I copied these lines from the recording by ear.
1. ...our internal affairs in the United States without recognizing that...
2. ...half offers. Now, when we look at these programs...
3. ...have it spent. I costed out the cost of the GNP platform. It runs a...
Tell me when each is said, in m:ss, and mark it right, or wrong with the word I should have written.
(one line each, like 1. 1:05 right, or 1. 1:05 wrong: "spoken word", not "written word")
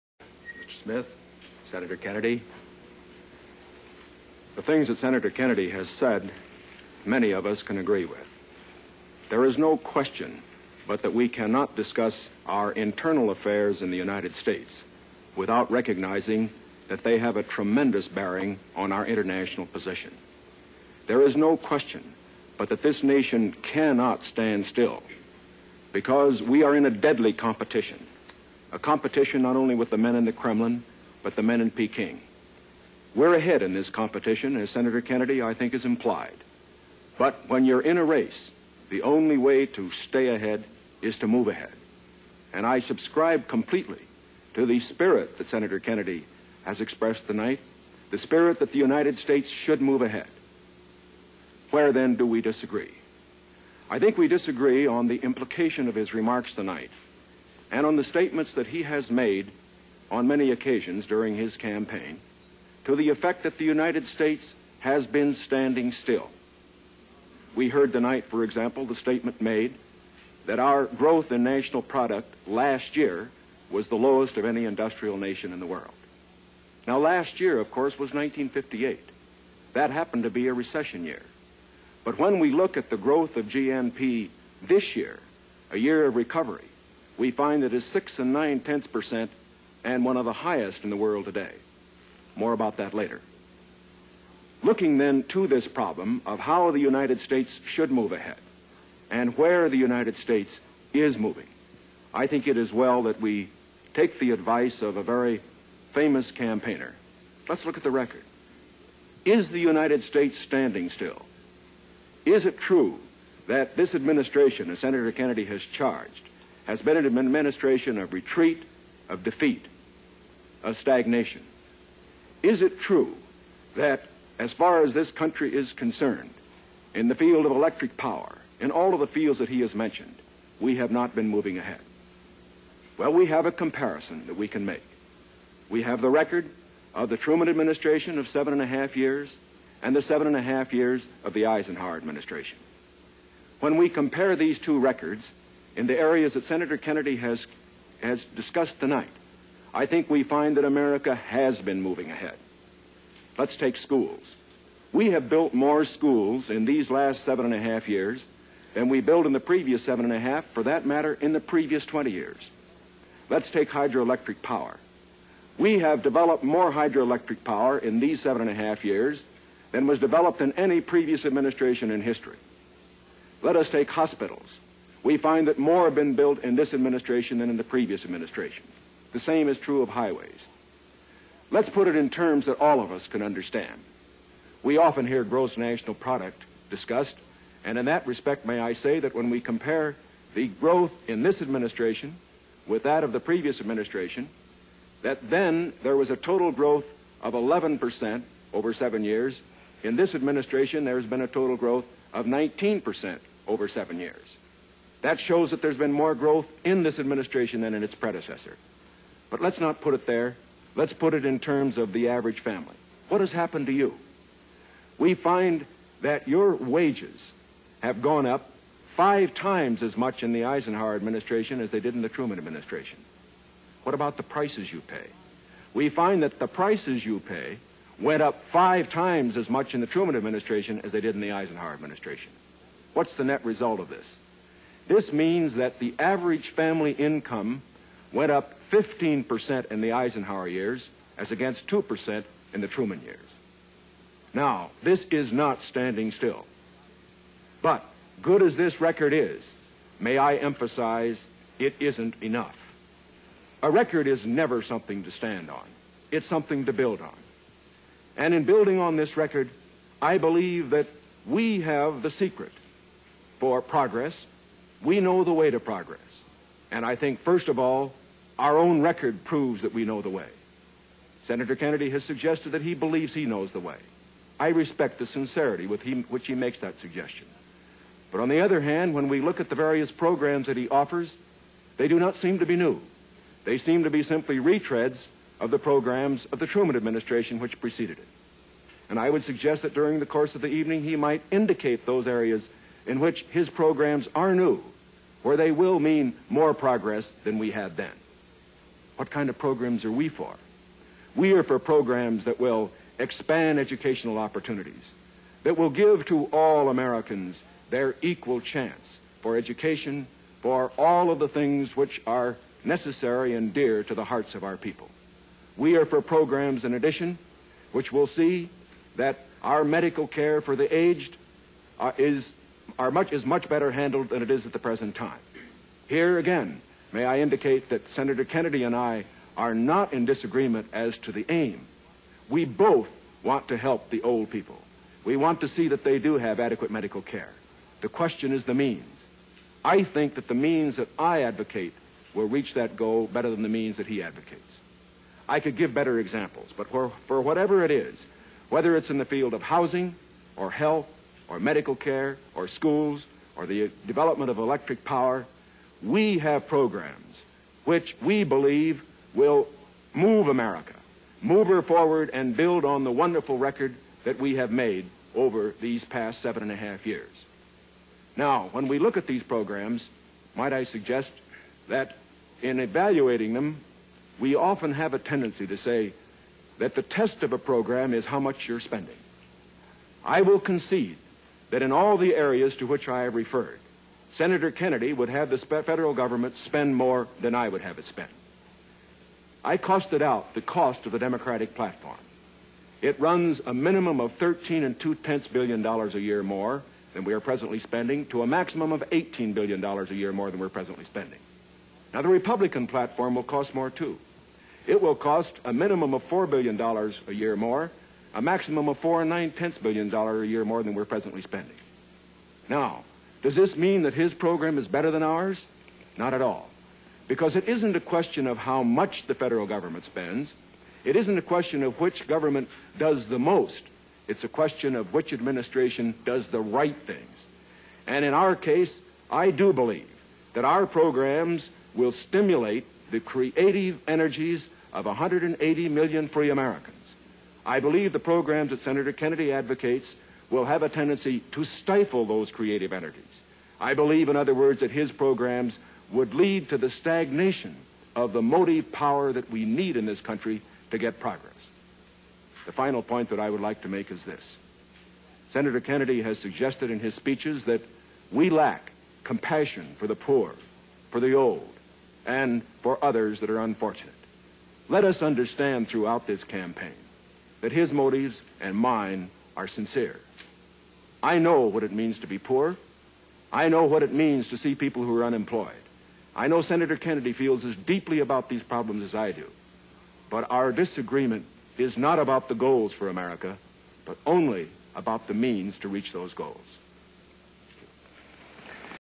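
1. 0:12 right
2. 6:06 wrong: "years", not "offers"
3. 6:27 wrong: "Democratic", not "GNP".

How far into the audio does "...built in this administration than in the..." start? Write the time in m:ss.
2:56.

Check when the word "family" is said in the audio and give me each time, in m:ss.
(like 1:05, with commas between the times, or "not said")
3:32, 3:56.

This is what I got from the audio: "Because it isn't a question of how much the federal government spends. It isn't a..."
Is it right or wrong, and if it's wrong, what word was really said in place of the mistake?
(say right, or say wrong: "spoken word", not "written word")
right.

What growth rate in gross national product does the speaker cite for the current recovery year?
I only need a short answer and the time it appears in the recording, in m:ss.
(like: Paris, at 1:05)
6.9%, at 1:27.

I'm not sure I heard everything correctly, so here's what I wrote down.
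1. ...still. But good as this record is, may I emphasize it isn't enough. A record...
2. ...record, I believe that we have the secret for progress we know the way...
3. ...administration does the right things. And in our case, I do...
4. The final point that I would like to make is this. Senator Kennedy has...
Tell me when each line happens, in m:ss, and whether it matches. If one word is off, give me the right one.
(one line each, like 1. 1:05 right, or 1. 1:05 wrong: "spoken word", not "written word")
1. 4:06 right
2. 4:19 right
3. 7:05 right
4. 7:32 right.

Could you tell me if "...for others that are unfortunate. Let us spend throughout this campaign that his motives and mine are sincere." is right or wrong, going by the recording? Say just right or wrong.
wrong.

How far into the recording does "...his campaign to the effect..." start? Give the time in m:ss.
1:01.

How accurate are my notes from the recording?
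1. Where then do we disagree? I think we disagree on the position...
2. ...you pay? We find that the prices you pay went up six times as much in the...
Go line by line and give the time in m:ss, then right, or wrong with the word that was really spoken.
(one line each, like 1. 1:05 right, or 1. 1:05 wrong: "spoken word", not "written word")
1. 0:51 wrong: "implication", not "position"
2. 3:44 wrong: "five", not "six".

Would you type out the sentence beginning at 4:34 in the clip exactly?
I respect the sincerity with he, which he makes that suggestion.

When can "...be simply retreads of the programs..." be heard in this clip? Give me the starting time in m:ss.
4:43.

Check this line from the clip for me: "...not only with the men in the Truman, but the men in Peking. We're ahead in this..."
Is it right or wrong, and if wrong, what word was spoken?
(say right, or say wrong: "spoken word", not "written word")
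wrong: "Kremlin", not "Truman".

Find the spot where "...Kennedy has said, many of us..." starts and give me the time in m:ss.
0:05.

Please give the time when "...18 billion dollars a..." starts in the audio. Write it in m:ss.
6:38.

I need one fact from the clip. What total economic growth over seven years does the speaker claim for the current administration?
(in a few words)
19%.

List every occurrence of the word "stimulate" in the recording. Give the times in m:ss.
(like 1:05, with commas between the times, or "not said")
7:11.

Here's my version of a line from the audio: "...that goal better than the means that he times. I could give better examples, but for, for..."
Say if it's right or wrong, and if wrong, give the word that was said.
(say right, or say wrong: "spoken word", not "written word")
wrong: "advocates", not "times".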